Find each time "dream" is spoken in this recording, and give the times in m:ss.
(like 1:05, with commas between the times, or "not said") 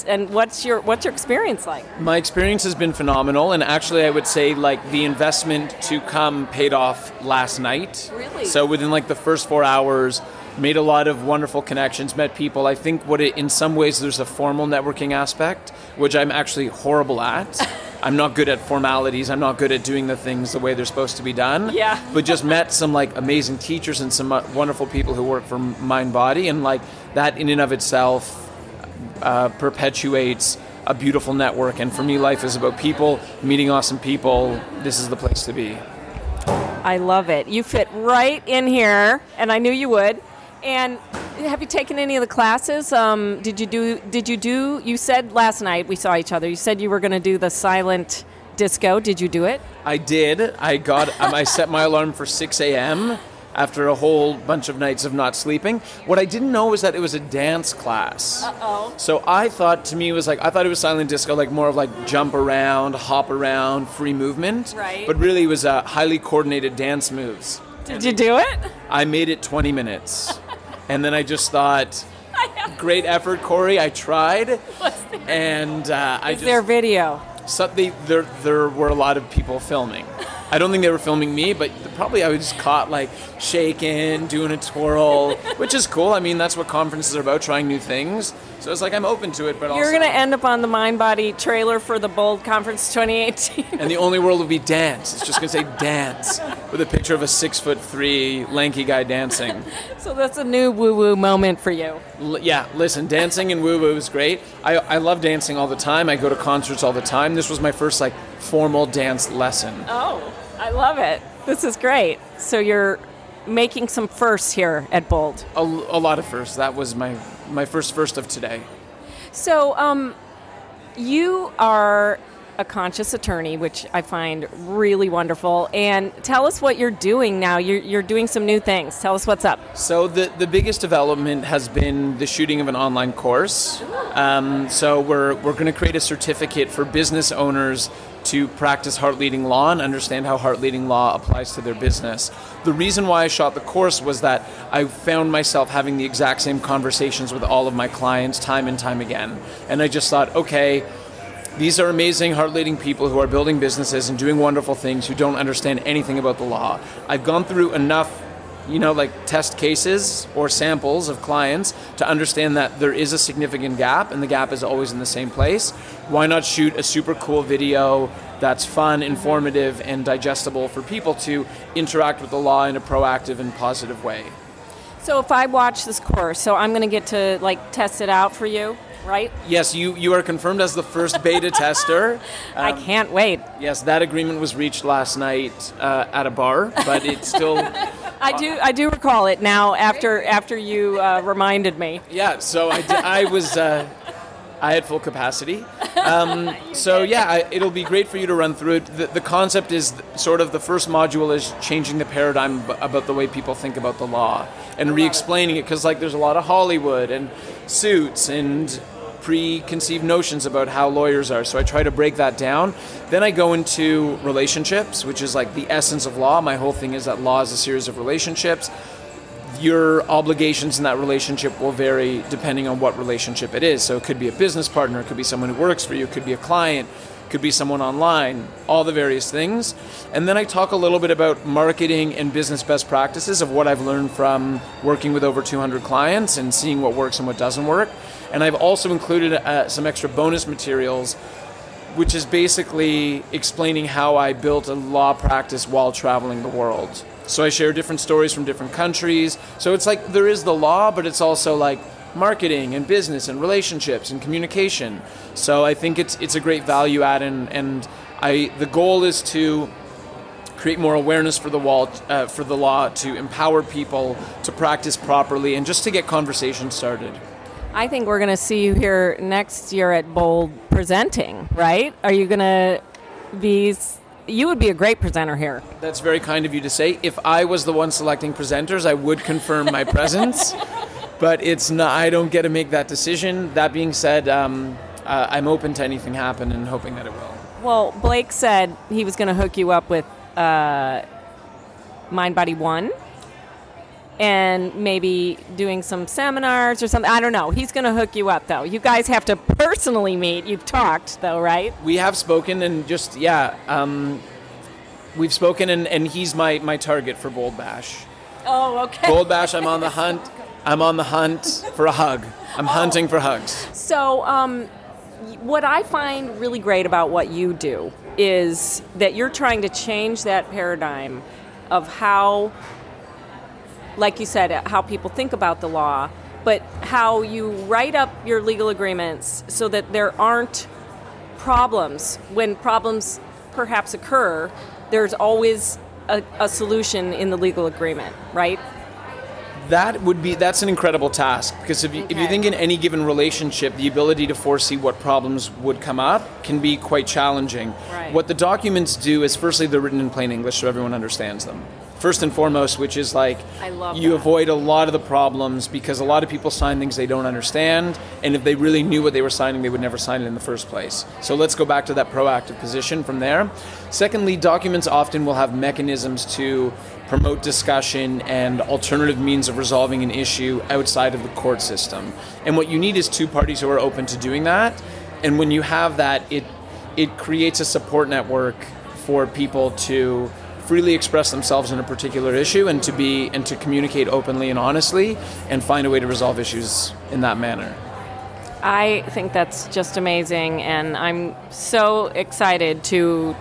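not said.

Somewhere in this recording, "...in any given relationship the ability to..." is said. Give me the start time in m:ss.
5:42.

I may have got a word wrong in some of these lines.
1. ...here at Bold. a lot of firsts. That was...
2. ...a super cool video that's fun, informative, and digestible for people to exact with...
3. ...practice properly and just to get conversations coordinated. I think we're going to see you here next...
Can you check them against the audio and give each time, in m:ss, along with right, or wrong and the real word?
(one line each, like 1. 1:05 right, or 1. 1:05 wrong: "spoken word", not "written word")
1. 1:54 right
2. 2:46 wrong: "interact", not "exact"
3. 4:24 wrong: "started", not "coordinated".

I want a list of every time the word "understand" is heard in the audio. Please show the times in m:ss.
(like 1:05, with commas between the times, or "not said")
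2:19, 2:35, 2:42, 5:50, 5:57.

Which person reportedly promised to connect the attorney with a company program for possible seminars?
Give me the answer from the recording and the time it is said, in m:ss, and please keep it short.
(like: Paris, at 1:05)
Blake, at 4:48.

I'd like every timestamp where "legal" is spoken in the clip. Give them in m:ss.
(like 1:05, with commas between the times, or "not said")
5:28, 5:37.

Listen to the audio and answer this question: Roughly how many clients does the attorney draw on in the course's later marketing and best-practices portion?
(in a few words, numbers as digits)
over 200.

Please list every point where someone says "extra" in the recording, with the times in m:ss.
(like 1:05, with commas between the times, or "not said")
3:59.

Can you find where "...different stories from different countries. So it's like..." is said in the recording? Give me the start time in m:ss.
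4:07.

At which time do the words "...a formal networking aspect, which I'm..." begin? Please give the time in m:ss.
0:14.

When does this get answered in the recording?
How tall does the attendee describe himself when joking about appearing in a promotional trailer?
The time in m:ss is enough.
1:37.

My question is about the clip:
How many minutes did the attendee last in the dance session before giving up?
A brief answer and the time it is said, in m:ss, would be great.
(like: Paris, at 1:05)
20, at 1:09.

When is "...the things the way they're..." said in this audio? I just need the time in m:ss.
0:20.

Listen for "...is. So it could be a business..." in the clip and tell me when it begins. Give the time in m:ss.
3:43.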